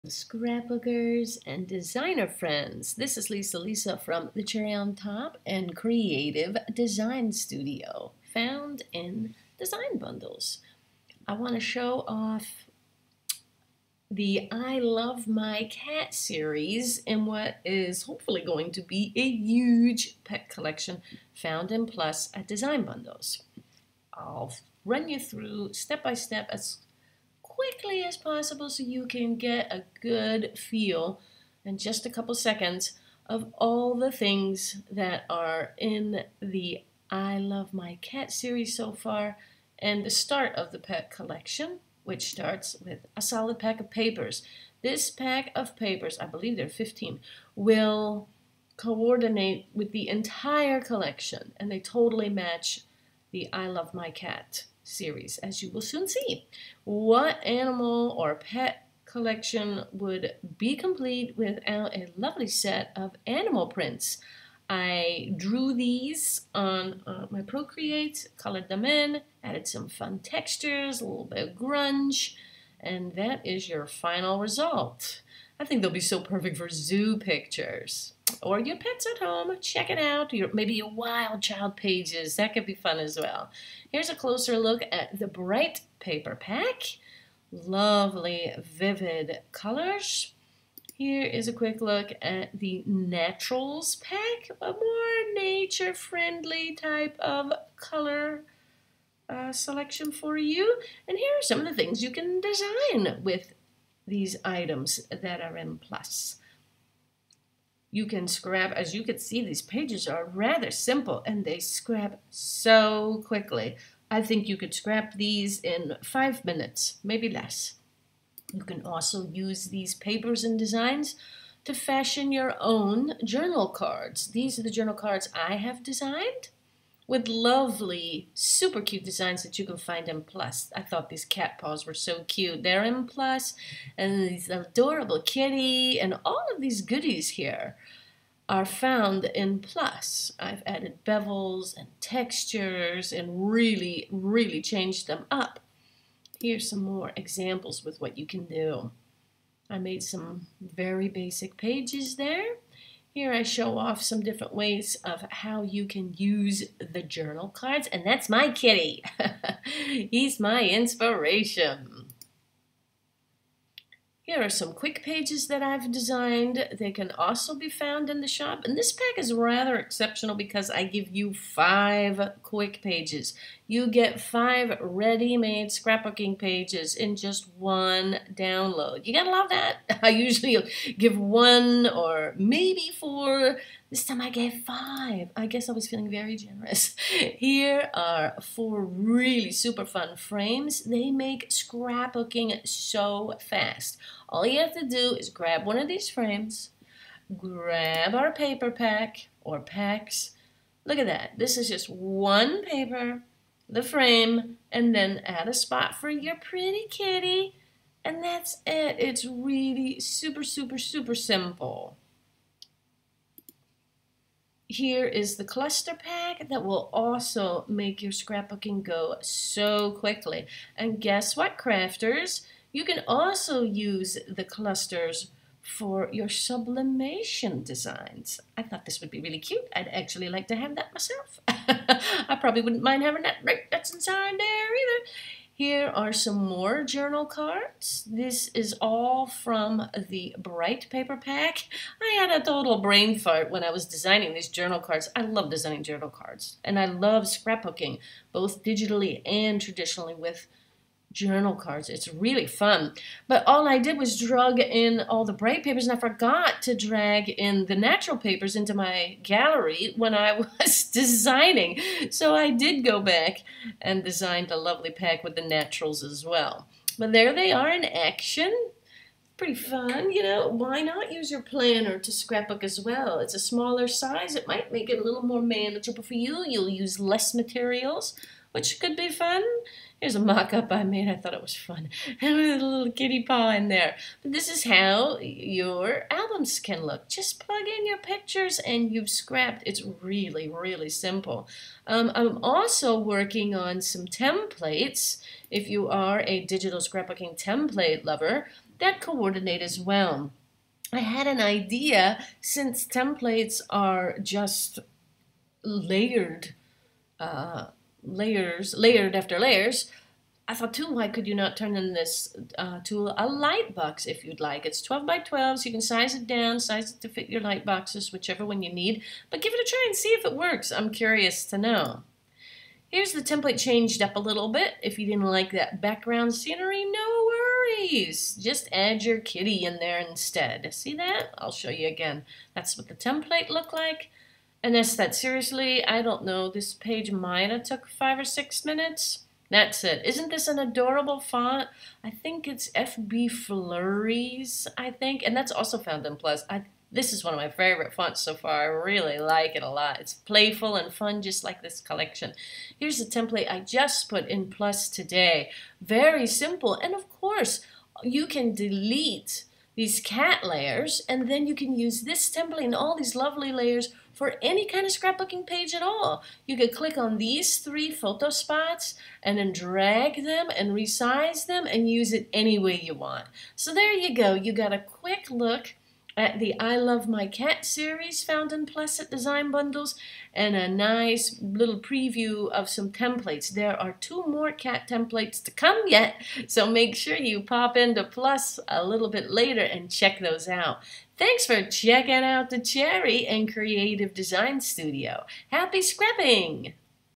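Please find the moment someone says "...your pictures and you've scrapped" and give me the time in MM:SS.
04:47.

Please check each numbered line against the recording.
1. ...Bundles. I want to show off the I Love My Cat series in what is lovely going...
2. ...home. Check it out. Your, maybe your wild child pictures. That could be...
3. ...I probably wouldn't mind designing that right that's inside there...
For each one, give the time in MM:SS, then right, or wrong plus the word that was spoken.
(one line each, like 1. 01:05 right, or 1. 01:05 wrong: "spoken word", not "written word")
1. 00:09 wrong: "hopefully", not "lovely"
2. 01:19 wrong: "pages", not "pictures"
3. 03:51 wrong: "having", not "designing".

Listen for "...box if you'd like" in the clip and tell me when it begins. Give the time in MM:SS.
05:13.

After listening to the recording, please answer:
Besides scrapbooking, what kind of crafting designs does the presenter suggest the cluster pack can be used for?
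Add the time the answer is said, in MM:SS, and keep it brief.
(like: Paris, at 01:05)
sublimation designs, at 03:46.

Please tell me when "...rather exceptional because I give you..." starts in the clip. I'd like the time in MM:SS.
02:49.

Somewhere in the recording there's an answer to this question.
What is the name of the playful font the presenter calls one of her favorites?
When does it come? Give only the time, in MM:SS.
05:42.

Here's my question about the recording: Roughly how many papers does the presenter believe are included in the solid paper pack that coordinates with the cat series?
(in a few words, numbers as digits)
15.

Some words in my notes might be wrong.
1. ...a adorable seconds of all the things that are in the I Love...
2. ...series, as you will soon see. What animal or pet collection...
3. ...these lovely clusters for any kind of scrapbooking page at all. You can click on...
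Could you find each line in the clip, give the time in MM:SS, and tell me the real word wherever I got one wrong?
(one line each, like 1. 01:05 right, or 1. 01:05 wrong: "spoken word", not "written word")
1. 00:32 wrong: "couple", not "adorable"
2. 00:54 right
3. 06:02 wrong: "layers", not "clusters".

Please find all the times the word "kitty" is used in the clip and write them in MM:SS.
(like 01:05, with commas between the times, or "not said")
02:15, 02:38, 03:26, 04:42, 05:29.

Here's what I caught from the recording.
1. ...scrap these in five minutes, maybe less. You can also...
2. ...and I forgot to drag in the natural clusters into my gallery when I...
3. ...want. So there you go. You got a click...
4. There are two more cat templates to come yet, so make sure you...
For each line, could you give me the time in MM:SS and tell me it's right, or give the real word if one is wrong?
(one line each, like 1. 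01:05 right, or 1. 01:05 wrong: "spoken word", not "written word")
1. 01:54 right
2. 04:15 wrong: "papers", not "clusters"
3. 06:12 wrong: "quick", not "click"
4. 06:23 right.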